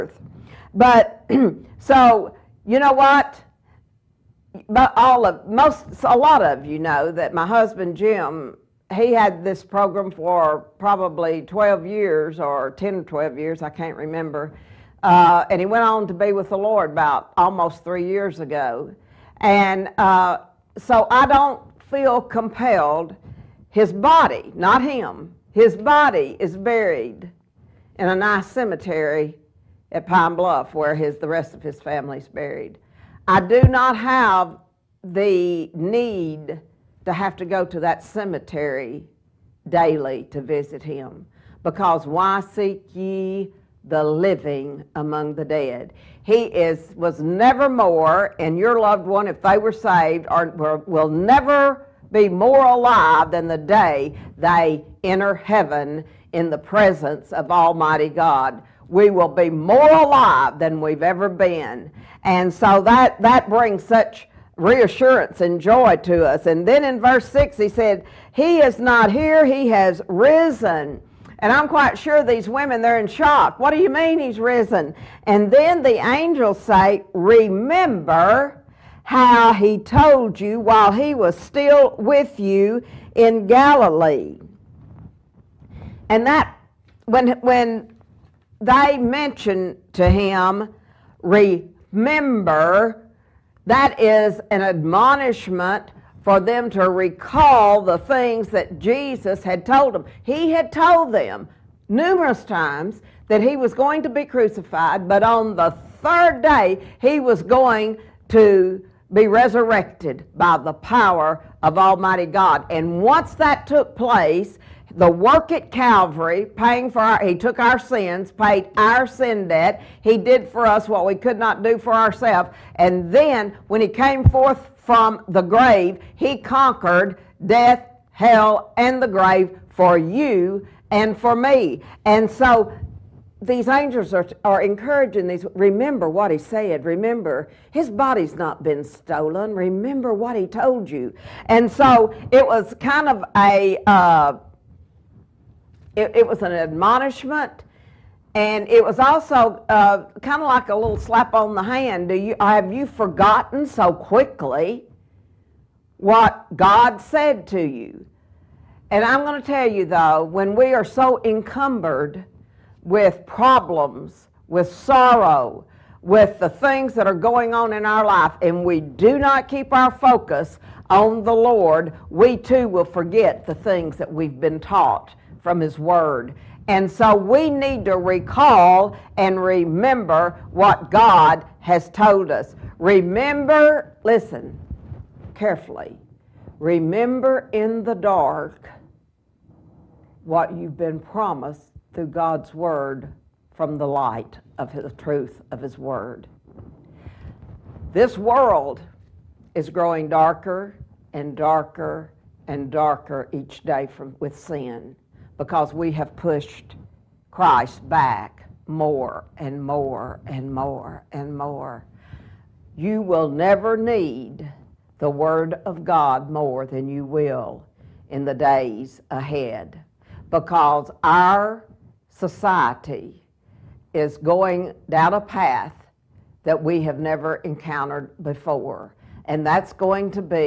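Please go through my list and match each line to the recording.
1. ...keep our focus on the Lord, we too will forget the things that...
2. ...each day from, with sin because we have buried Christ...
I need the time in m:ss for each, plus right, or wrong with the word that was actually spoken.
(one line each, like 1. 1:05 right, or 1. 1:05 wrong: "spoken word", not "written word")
1. 2:49 right
2. 3:23 wrong: "pushed", not "buried".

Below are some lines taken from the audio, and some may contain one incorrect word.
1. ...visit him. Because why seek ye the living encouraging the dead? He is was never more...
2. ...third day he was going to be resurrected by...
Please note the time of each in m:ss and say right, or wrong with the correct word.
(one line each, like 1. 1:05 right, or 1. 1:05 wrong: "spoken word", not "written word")
1. 0:40 wrong: "among", not "encouraging"
2. 1:46 right.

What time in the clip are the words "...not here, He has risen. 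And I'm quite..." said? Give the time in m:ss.
1:08.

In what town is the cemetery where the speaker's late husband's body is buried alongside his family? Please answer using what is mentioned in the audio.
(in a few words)
Pine Bluff.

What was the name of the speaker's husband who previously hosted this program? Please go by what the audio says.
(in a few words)
Jim.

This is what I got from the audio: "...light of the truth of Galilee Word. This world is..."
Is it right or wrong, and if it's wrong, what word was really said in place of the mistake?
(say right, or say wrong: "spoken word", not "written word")
wrong: "His", not "Galilee".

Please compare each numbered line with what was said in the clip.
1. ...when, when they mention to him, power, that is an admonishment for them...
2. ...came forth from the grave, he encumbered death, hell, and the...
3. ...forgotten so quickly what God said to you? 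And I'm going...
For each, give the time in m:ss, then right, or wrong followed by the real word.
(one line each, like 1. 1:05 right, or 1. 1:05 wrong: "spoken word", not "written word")
1. 1:27 wrong: "remember", not "power"
2. 2:03 wrong: "conquered", not "encumbered"
3. 2:32 right.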